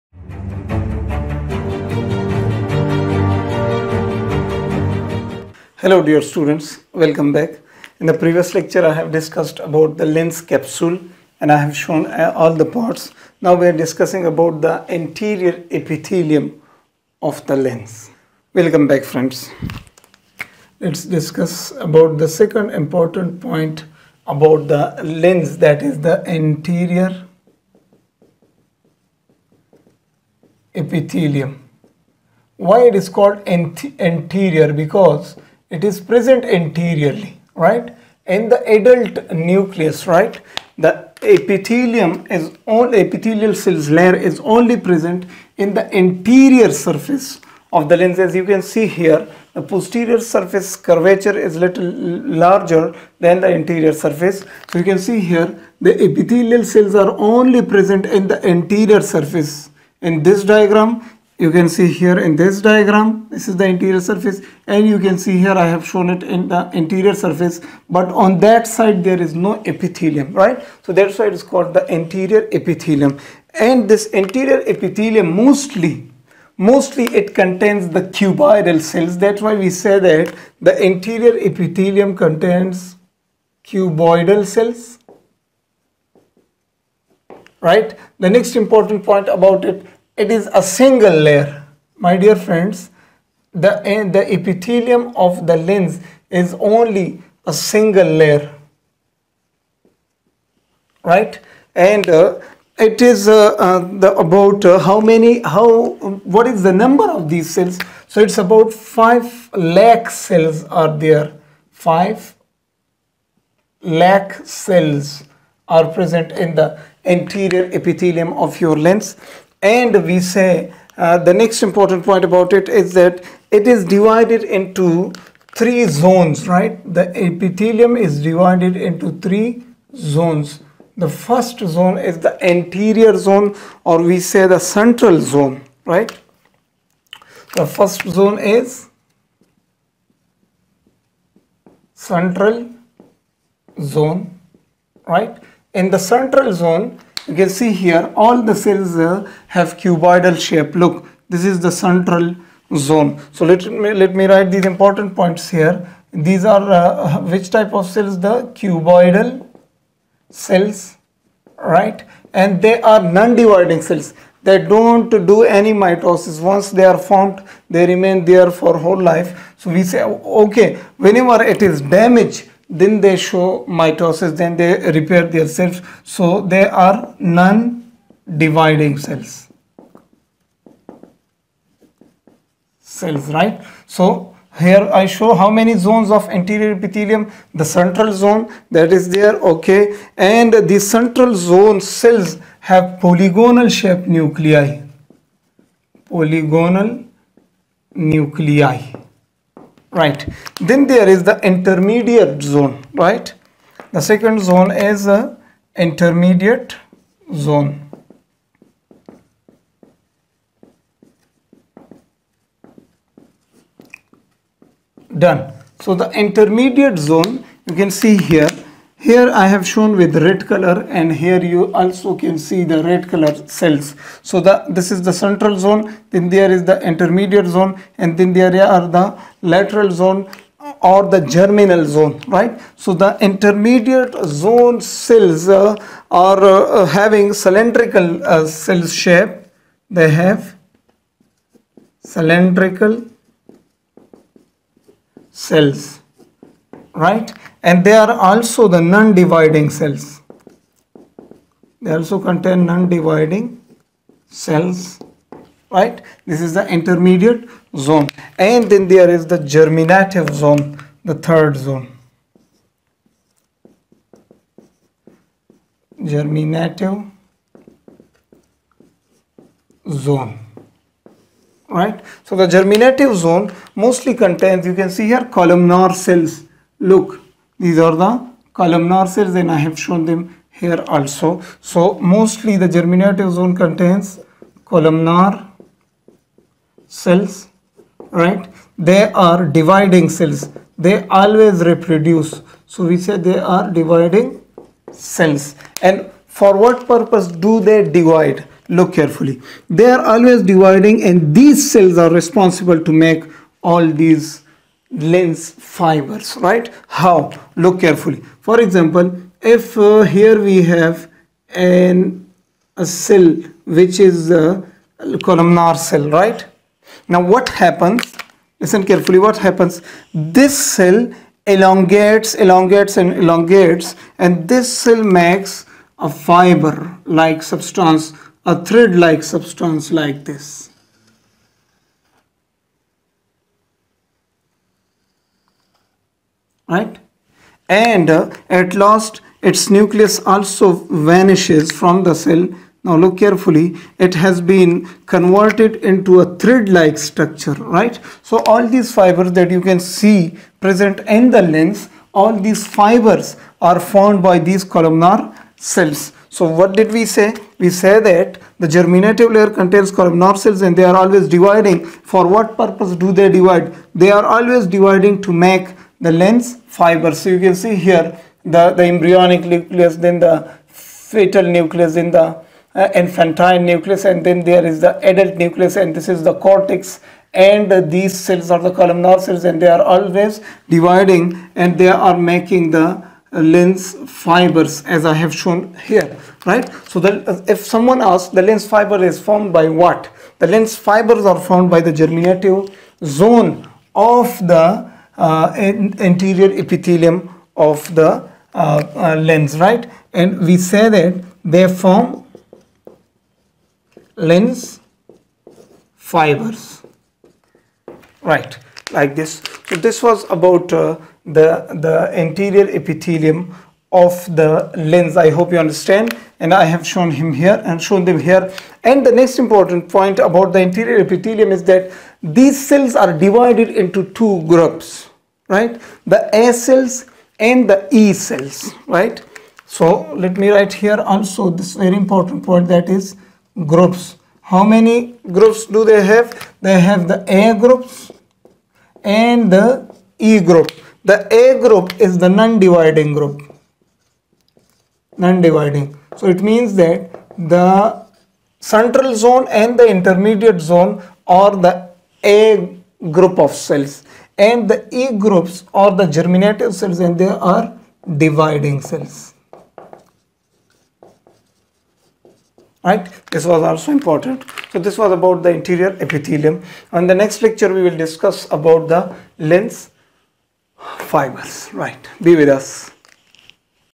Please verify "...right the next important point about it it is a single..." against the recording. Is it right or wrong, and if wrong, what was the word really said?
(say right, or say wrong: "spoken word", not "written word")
right.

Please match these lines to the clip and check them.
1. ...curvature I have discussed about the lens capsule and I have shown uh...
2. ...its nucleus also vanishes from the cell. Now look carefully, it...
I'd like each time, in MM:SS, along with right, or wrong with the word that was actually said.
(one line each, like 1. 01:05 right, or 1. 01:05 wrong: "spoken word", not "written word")
1. 00:08 wrong: "lecture", not "curvature"
2. 05:39 right.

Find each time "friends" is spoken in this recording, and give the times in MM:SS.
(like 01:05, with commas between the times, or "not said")
00:19, 01:32.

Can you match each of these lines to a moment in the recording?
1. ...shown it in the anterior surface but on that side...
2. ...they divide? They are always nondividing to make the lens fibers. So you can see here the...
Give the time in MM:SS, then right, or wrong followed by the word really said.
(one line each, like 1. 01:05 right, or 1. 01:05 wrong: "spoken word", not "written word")
1. 01:05 right
2. 06:03 wrong: "dividing", not "nondividing".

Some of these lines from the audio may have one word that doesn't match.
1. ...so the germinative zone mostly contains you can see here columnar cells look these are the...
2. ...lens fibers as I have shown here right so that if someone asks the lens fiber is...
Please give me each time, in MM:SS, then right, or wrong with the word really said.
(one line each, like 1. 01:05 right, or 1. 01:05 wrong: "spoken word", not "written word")
1. 04:32 right
2. 06:23 right.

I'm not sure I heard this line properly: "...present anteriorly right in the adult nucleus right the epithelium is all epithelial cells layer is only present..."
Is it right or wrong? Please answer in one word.
right.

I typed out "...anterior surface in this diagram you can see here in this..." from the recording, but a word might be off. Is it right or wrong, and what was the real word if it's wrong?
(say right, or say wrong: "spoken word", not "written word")
right.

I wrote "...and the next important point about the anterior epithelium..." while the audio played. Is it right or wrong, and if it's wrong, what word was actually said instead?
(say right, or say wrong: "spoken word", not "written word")
right.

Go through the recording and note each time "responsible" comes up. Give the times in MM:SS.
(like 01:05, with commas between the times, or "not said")
05:02.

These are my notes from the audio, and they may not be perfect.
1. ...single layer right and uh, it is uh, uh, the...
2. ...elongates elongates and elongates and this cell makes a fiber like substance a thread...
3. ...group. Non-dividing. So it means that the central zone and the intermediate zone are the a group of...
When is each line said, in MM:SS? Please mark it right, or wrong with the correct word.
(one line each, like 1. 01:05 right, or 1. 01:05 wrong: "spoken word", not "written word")
1. 01:37 right
2. 05:21 right
3. 07:23 right.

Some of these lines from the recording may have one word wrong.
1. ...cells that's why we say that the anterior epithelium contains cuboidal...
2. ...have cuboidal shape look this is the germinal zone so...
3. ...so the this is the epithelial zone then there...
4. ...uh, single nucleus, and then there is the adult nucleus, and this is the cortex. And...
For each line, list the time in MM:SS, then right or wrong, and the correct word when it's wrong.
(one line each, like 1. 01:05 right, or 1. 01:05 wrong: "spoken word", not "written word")
1. 01:18 right
2. 02:29 wrong: "central", not "germinal"
3. 03:44 wrong: "central", not "epithelial"
4. 06:12 wrong: "infantile", not "single".